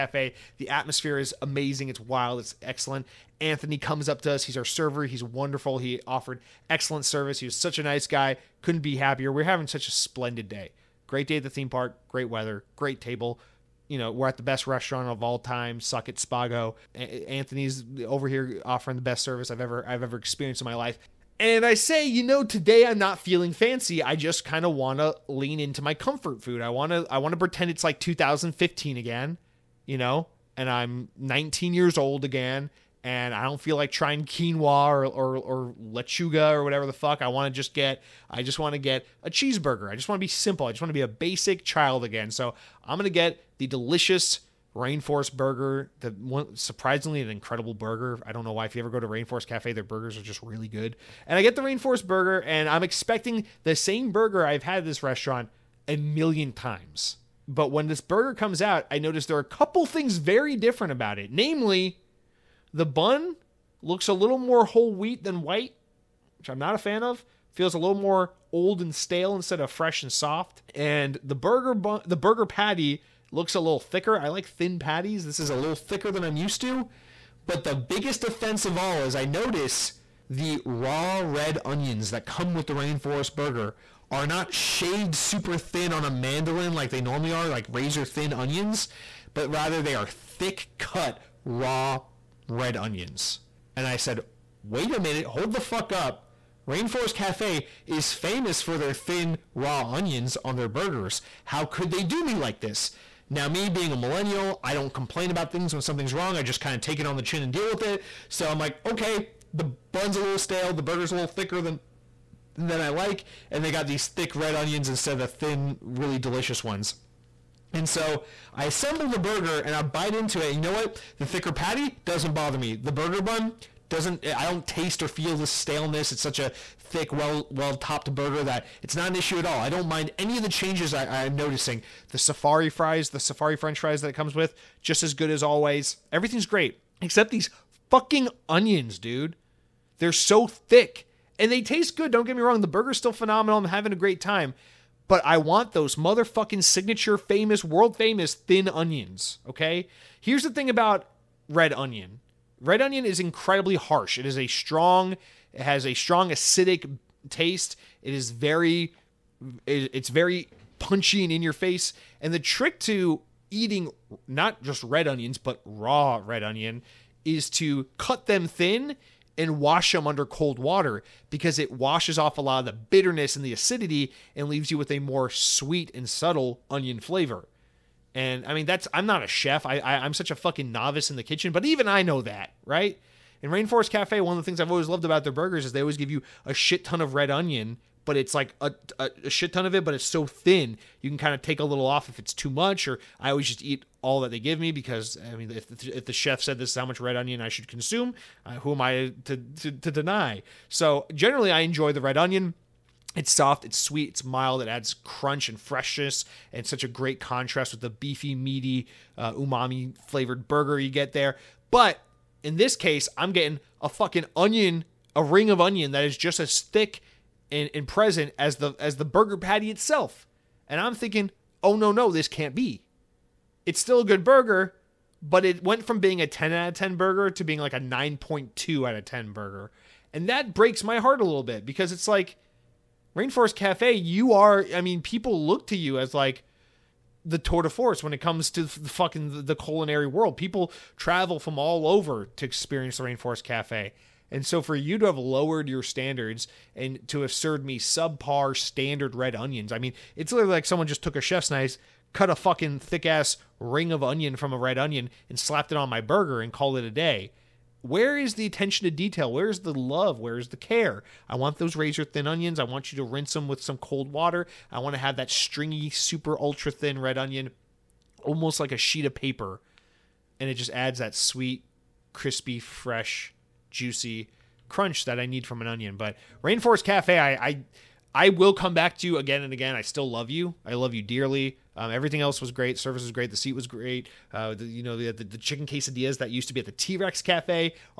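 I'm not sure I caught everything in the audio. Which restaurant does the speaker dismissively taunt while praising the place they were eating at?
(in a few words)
Spago.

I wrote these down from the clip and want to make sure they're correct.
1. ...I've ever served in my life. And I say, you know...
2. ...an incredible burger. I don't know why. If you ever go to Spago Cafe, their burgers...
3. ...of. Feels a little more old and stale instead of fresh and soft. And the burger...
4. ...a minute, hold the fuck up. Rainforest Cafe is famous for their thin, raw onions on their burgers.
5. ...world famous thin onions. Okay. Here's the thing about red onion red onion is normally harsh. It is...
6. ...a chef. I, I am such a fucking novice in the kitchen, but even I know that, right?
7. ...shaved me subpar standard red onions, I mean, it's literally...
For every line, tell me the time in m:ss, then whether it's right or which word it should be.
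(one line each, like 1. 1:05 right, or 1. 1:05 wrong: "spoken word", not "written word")
1. 0:19 wrong: "experienced", not "served"
2. 0:47 wrong: "Rainforest", not "Spago"
3. 1:07 right
4. 1:34 right
5. 2:27 wrong: "incredibly", not "normally"
6. 2:59 right
7. 4:07 wrong: "served", not "shaved".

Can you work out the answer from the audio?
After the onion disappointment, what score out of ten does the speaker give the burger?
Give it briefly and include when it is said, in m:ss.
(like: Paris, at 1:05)
9.2, at 3:47.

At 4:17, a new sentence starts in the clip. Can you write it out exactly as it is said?
Where is the attention to detail?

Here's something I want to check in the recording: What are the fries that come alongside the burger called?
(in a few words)
Safari fries.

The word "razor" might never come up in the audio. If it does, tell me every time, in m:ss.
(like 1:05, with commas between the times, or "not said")
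1:27, 4:21.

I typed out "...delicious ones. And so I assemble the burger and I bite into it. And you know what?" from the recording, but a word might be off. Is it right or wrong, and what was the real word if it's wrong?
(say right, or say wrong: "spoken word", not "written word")
right.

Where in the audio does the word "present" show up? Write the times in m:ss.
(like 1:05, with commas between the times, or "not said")
3:37.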